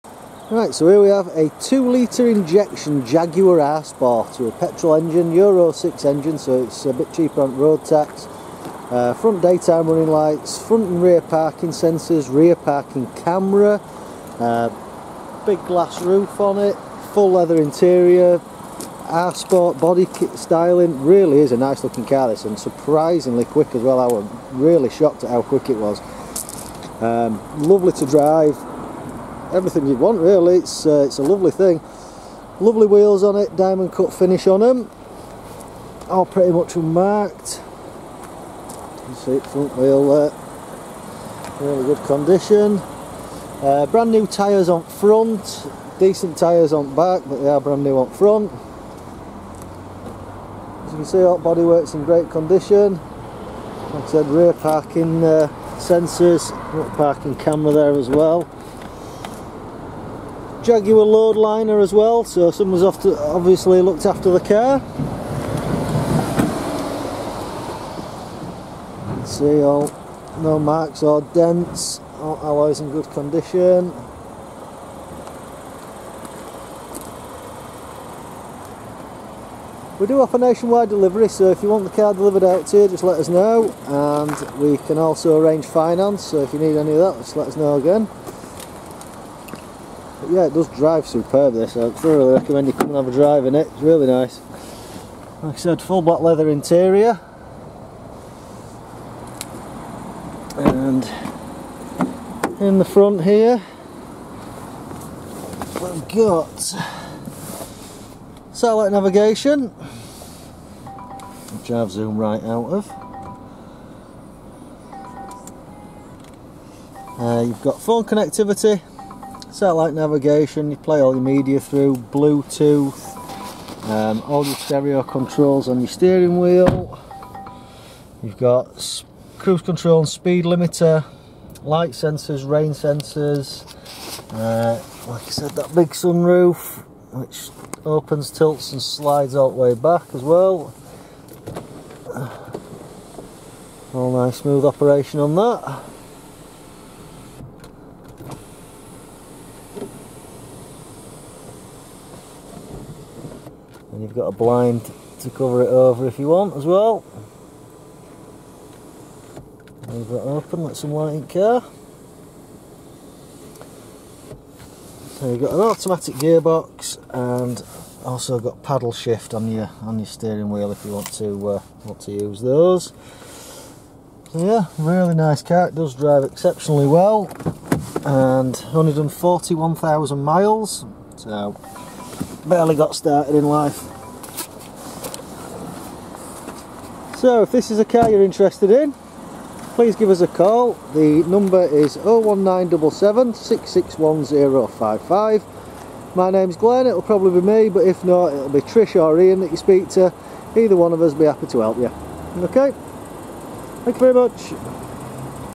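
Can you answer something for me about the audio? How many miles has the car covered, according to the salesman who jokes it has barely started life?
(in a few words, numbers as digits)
141,000.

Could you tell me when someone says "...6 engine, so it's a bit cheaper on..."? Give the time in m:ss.
0:05.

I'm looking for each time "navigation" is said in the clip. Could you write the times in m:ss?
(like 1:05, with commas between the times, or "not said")
1:48, 1:59.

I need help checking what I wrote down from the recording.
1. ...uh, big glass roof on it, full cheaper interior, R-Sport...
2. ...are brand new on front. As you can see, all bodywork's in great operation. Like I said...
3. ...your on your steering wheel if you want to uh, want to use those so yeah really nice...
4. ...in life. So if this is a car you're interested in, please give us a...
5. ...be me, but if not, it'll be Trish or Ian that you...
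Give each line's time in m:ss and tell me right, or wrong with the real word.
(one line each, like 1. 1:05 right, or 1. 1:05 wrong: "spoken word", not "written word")
1. 0:14 wrong: "leather", not "cheaper"
2. 0:47 wrong: "condition", not "operation"
3. 2:49 right
4. 3:03 right
5. 3:17 right.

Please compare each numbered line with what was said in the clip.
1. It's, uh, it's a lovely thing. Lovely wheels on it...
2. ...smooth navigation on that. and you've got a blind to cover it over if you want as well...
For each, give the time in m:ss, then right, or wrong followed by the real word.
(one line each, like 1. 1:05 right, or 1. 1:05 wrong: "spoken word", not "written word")
1. 0:30 right
2. 2:24 wrong: "operation", not "navigation".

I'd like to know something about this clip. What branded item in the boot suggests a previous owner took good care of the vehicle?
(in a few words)
Jaguar load liner.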